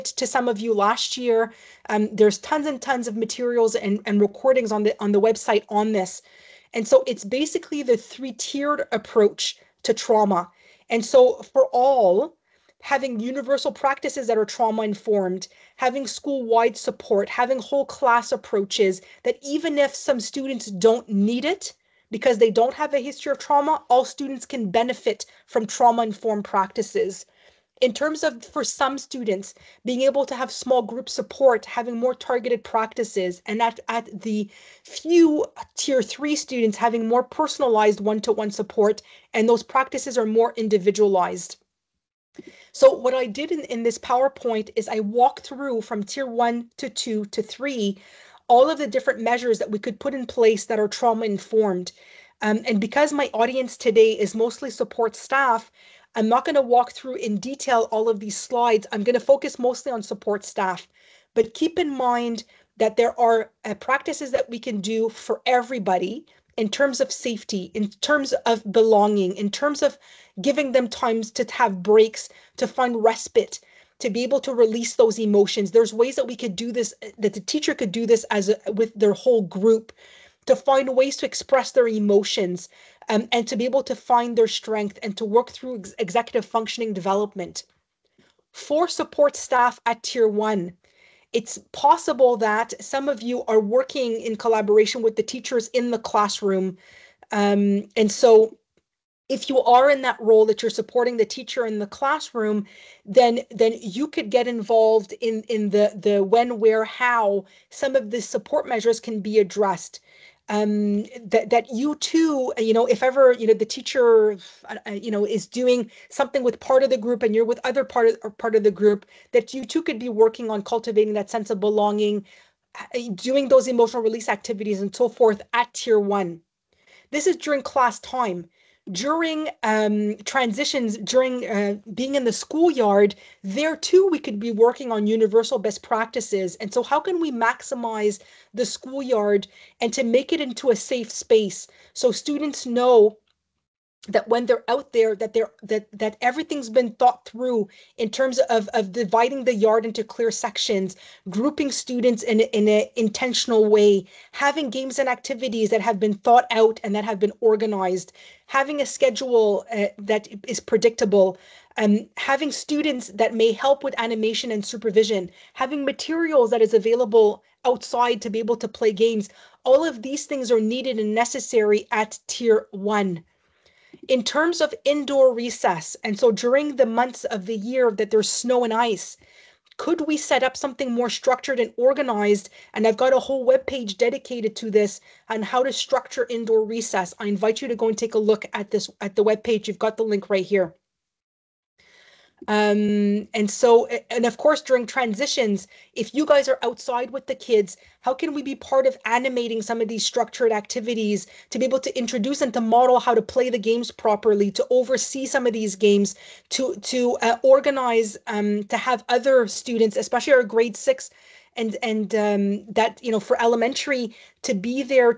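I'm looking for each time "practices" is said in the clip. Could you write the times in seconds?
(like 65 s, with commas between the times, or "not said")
13 s, 26 s, 32 s, 39 s, 63 s, 135 s.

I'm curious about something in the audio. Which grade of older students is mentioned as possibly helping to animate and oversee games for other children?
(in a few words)
grade 6.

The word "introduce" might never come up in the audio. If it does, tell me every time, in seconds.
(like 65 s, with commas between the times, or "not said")
201 s.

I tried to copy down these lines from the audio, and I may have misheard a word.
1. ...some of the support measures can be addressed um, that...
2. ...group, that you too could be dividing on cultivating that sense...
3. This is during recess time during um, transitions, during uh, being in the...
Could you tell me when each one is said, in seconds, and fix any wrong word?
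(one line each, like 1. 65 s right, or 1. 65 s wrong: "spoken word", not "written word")
1. 107 s right
2. 118 s wrong: "working", not "dividing"
3. 127 s wrong: "class", not "recess".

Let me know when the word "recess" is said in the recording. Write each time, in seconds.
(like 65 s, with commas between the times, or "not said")
175 s, 186 s.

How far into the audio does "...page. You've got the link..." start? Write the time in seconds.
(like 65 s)
189 s.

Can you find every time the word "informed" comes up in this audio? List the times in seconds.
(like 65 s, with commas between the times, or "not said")
14 s, 26 s, 51 s.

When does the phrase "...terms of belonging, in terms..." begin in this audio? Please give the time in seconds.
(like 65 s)
67 s.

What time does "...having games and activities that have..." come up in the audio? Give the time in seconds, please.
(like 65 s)
154 s.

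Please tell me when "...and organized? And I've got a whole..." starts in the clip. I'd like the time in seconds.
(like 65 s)
181 s.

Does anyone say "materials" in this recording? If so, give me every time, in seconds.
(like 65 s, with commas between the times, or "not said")
3 s, 165 s.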